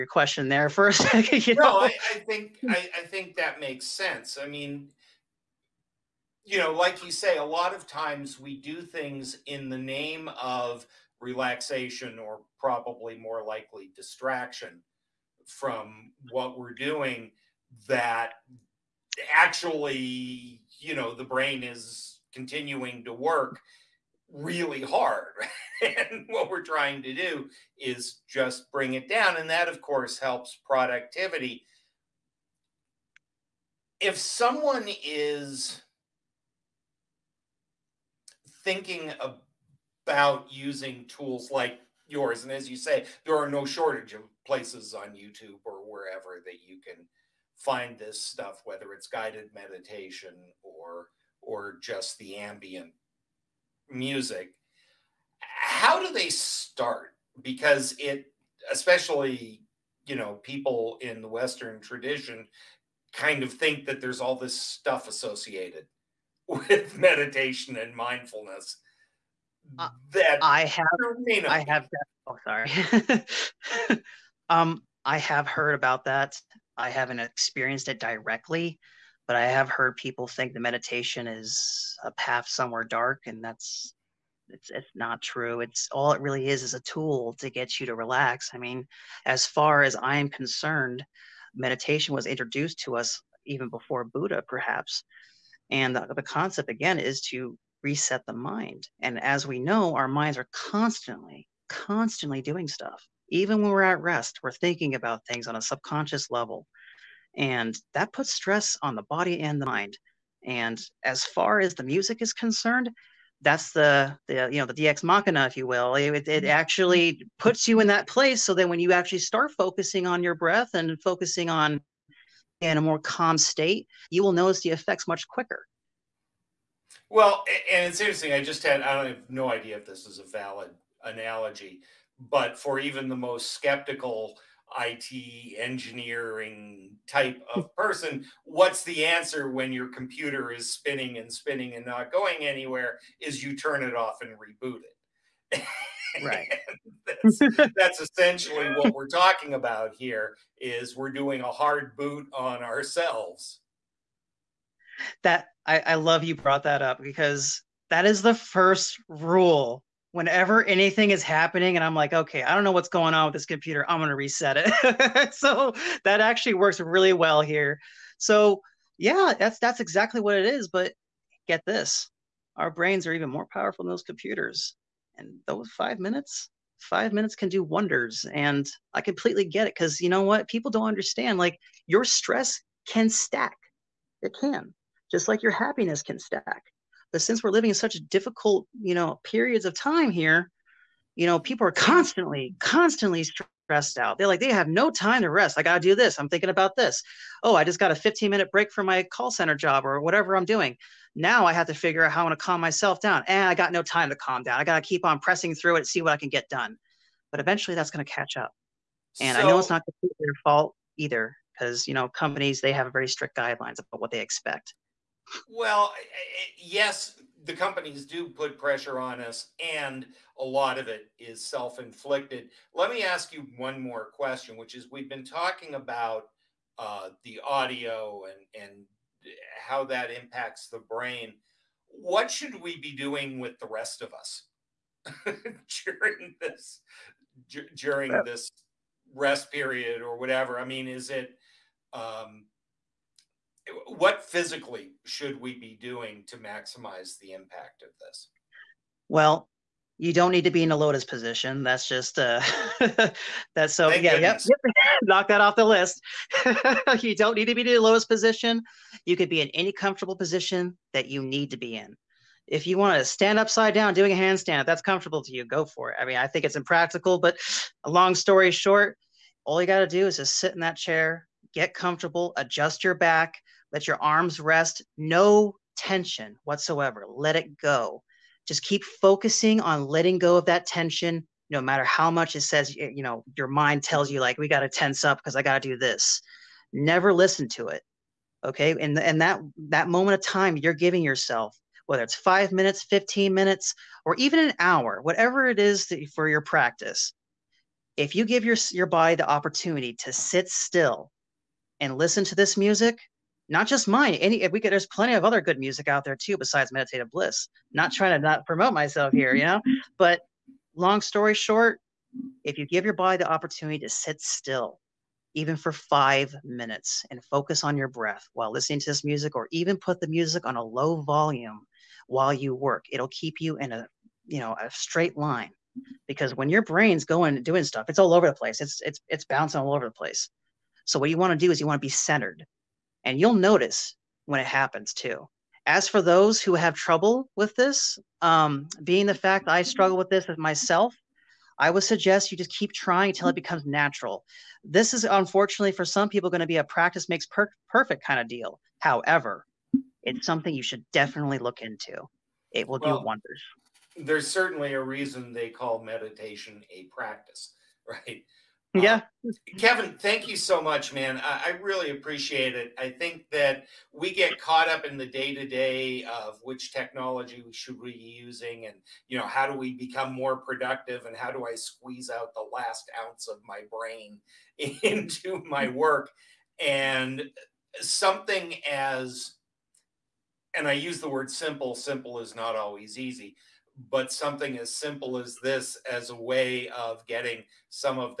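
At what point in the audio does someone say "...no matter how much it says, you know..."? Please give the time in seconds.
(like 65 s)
281 s.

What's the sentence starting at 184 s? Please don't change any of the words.
It can just like your happiness can stack.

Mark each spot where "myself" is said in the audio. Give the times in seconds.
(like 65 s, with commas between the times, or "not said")
202 s, 308 s, 340 s.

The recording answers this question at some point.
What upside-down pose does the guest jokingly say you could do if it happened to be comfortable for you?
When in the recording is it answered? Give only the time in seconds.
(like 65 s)
264 s.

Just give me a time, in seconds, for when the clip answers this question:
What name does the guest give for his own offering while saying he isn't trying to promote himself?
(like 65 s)
306 s.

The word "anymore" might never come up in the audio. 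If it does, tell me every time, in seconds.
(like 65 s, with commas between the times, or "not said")
not said.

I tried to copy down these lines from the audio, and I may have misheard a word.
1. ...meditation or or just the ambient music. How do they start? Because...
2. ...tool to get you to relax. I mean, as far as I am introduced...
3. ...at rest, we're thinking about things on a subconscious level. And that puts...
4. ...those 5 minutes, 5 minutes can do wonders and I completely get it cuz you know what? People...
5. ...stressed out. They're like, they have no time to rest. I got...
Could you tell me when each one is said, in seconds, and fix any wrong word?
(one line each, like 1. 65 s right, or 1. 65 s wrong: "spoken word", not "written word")
1. 49 s right
2. 86 s wrong: "concerned", not "introduced"
3. 103 s right
4. 175 s right
5. 193 s right.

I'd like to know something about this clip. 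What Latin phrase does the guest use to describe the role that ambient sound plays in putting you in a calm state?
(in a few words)
deus ex machina.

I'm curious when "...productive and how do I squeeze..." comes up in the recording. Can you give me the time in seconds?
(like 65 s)
370 s.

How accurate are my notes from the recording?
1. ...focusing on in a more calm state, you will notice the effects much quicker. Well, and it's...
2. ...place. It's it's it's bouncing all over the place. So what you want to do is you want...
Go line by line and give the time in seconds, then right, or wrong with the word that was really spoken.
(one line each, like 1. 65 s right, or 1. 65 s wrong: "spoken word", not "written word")
1. 121 s right
2. 328 s right.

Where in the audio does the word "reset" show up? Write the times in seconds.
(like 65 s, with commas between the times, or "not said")
97 s, 164 s.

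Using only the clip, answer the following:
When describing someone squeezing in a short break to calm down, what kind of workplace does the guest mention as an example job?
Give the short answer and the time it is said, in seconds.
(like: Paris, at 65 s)
call center, at 199 s.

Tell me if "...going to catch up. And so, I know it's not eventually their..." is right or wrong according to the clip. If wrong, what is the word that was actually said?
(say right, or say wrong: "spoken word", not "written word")
wrong: "completely", not "eventually".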